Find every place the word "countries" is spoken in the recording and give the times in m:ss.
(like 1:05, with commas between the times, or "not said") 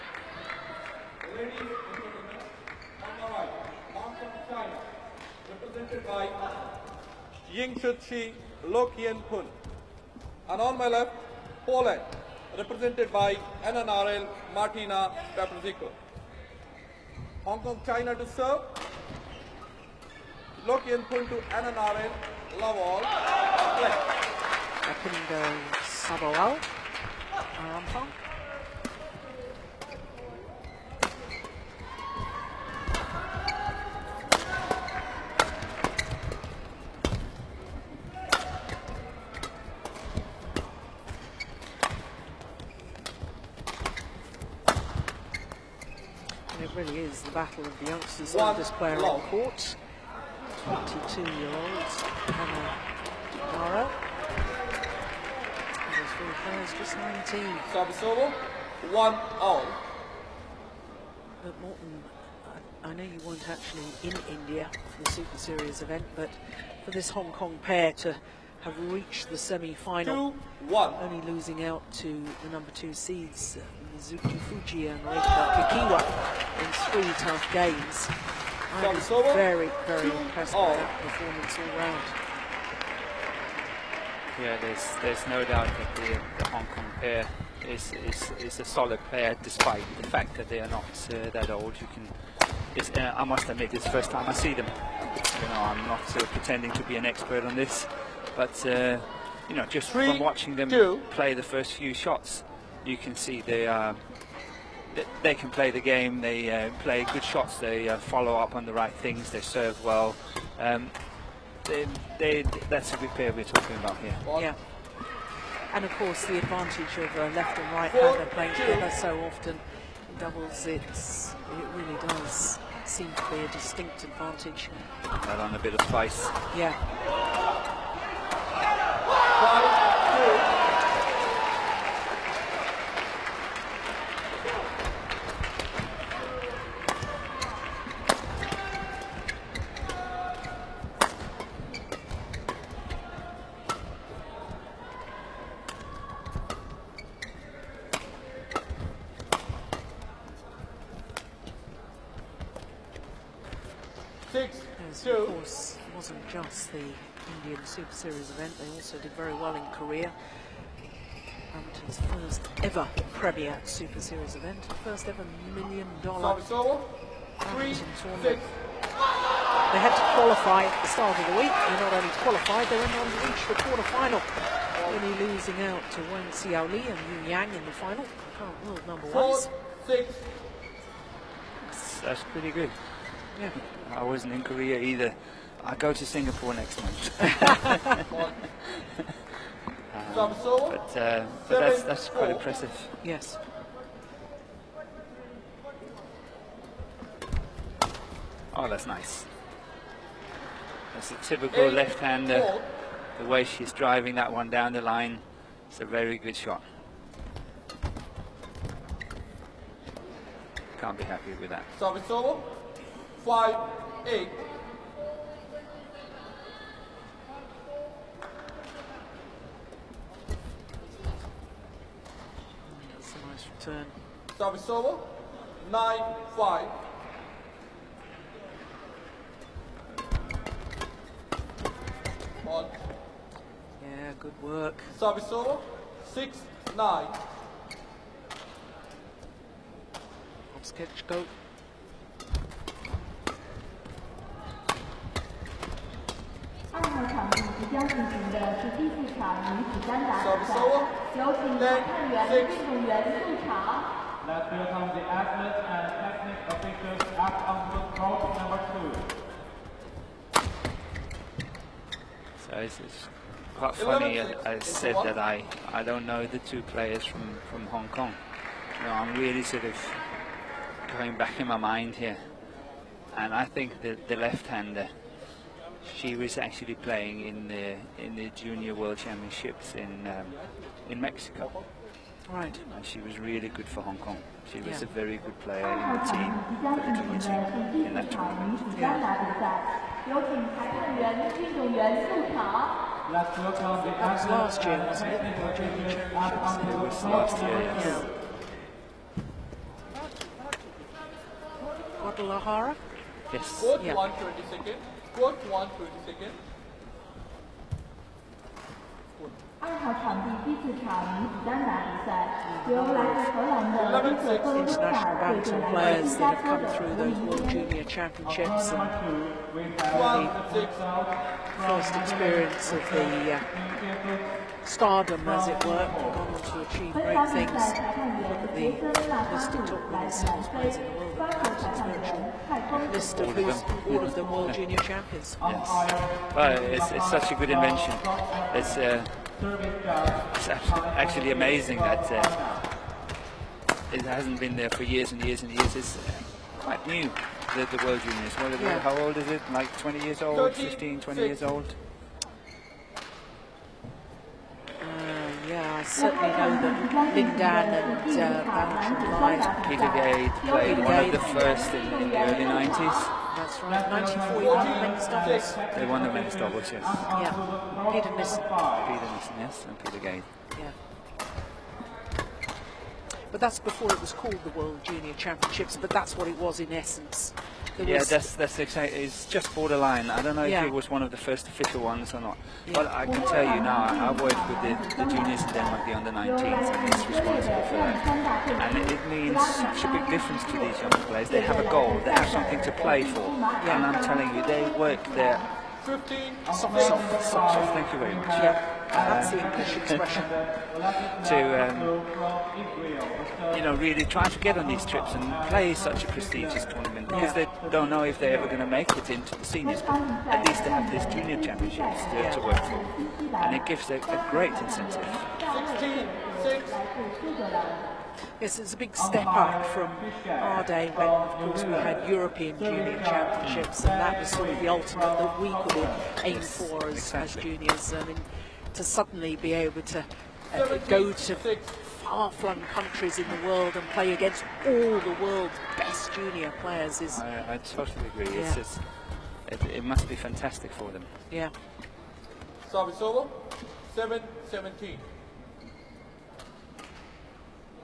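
7:12.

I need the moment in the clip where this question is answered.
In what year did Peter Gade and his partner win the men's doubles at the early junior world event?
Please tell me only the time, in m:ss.
6:03.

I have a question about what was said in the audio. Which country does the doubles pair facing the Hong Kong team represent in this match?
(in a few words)
Poland.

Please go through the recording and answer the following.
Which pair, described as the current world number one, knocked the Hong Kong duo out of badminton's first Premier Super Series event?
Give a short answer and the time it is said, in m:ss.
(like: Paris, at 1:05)
Wang Xiaoli and Yu Yang, at 2:56.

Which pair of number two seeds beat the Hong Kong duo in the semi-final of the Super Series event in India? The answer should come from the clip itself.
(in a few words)
Mizuki Fujii and Reika Kakiiwa.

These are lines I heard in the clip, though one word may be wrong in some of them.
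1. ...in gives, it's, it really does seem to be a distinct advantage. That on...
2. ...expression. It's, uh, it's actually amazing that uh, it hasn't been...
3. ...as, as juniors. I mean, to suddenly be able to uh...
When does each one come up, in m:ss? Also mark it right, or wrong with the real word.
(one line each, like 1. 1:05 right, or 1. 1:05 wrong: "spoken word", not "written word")
1. 2:00 wrong: "doubles", not "gives"
2. 5:37 wrong: "invention", not "expression"
3. 7:06 right.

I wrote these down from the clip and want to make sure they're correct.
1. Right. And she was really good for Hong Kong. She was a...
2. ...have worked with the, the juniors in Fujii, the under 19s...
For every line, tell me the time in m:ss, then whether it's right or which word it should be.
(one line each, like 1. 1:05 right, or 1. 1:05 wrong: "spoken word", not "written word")
1. 4:42 right
2. 6:23 wrong: "Denmark", not "Fujii".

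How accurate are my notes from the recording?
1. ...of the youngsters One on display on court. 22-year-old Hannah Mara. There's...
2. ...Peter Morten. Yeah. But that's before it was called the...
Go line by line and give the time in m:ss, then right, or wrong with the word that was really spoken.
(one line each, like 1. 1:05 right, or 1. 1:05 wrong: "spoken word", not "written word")
1. 0:47 right
2. 6:09 wrong: "Gade", not "Morten".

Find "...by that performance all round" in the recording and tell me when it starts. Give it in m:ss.
1:20.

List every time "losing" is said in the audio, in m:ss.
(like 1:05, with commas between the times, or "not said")
1:11, 2:55.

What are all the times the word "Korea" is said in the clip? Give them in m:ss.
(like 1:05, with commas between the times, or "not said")
2:39, 3:04.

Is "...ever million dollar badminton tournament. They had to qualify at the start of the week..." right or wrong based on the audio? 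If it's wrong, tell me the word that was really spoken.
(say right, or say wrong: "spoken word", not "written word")
right.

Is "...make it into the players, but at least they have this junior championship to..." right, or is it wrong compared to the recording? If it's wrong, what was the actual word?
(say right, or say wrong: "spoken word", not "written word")
wrong: "seniors", not "players".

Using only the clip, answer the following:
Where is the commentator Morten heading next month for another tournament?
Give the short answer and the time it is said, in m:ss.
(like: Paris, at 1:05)
Singapore, at 3:06.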